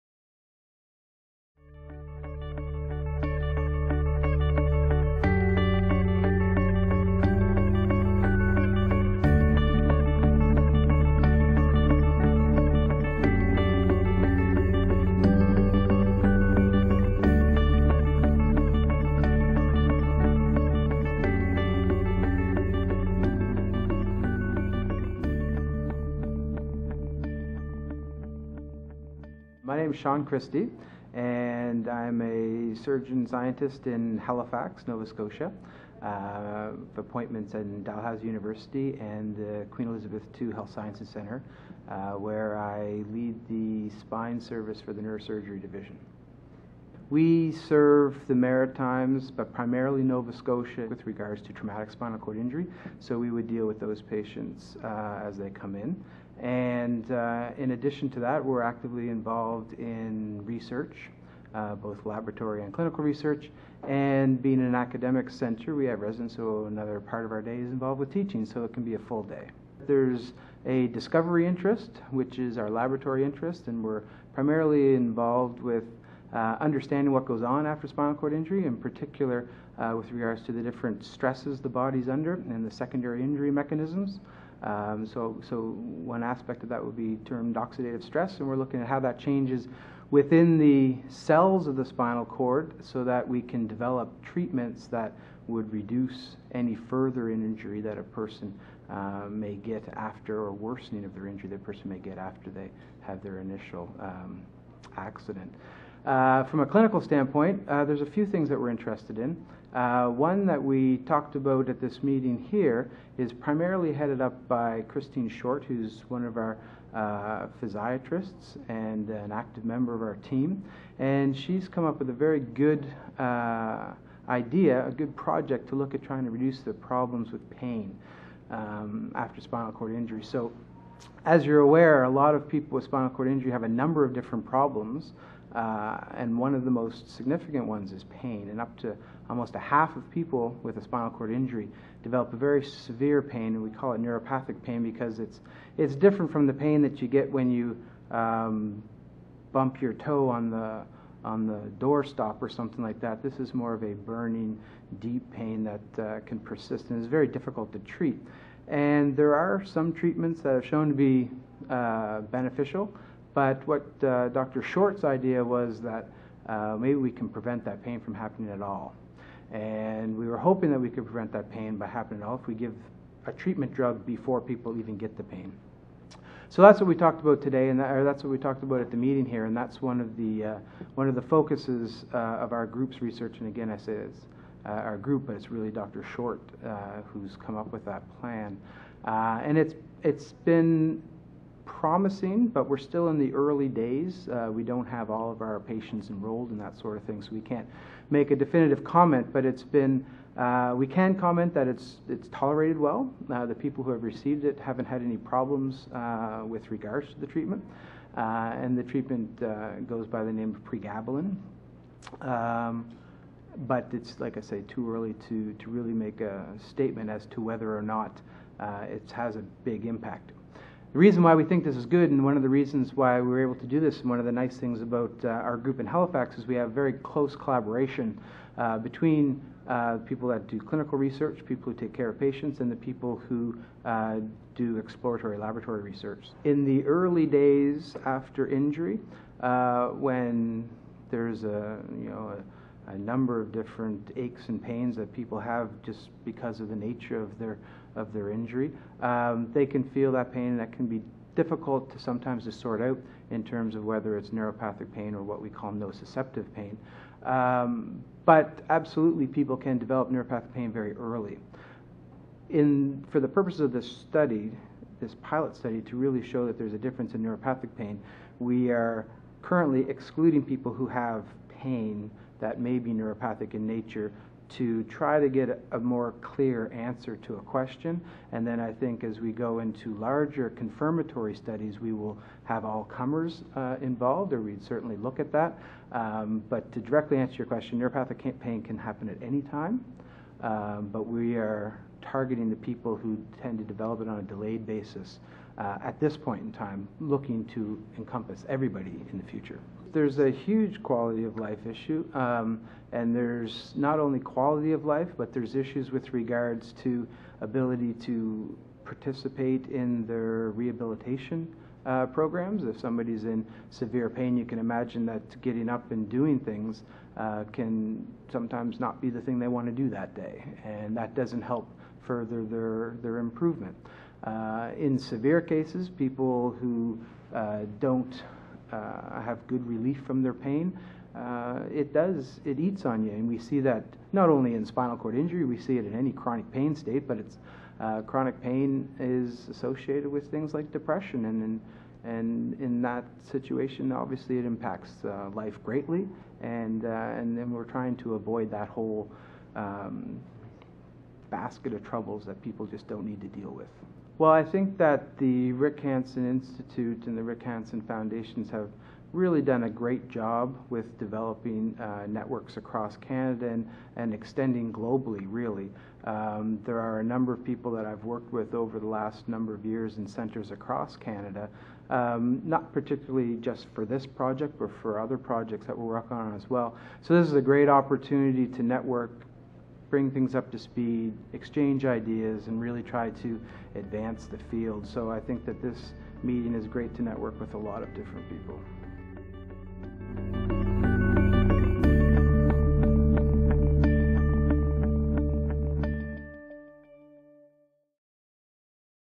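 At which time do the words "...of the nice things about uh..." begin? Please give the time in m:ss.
3:44.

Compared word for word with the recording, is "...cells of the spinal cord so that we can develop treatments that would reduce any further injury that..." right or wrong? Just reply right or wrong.
right.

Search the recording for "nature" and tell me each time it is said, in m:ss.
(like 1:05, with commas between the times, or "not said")
4:06, 4:33.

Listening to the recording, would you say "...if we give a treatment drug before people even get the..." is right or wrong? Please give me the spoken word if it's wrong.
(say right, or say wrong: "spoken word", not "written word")
right.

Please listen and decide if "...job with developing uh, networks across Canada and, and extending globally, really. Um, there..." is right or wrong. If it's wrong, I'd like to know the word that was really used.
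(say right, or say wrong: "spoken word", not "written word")
right.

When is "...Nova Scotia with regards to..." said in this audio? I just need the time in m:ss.
0:50.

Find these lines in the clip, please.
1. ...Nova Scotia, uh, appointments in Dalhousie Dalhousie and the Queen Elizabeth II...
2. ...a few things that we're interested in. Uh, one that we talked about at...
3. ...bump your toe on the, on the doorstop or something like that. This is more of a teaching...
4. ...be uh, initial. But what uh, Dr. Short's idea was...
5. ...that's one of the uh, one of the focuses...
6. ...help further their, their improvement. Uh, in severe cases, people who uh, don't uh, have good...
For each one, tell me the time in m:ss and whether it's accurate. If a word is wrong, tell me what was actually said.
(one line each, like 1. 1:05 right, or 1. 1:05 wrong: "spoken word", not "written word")
1. 0:34 wrong: "University", not "Dalhousie"
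2. 1:48 right
3. 2:29 wrong: "burning", not "teaching"
4. 2:40 wrong: "beneficial", not "initial"
5. 2:59 right
6. 5:21 right.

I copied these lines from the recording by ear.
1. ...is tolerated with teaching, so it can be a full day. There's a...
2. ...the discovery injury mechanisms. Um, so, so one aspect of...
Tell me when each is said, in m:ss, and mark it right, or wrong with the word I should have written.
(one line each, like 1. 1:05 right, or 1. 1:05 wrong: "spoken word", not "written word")
1. 1:07 wrong: "involved", not "tolerated"
2. 1:22 wrong: "secondary", not "discovery".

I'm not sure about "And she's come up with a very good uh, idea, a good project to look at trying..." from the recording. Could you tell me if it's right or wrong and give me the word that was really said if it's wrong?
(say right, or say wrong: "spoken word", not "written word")
right.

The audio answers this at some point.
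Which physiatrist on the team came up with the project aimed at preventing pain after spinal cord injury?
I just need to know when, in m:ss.
1:54.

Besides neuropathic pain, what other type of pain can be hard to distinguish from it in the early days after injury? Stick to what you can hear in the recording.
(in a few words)
nociceptive pain.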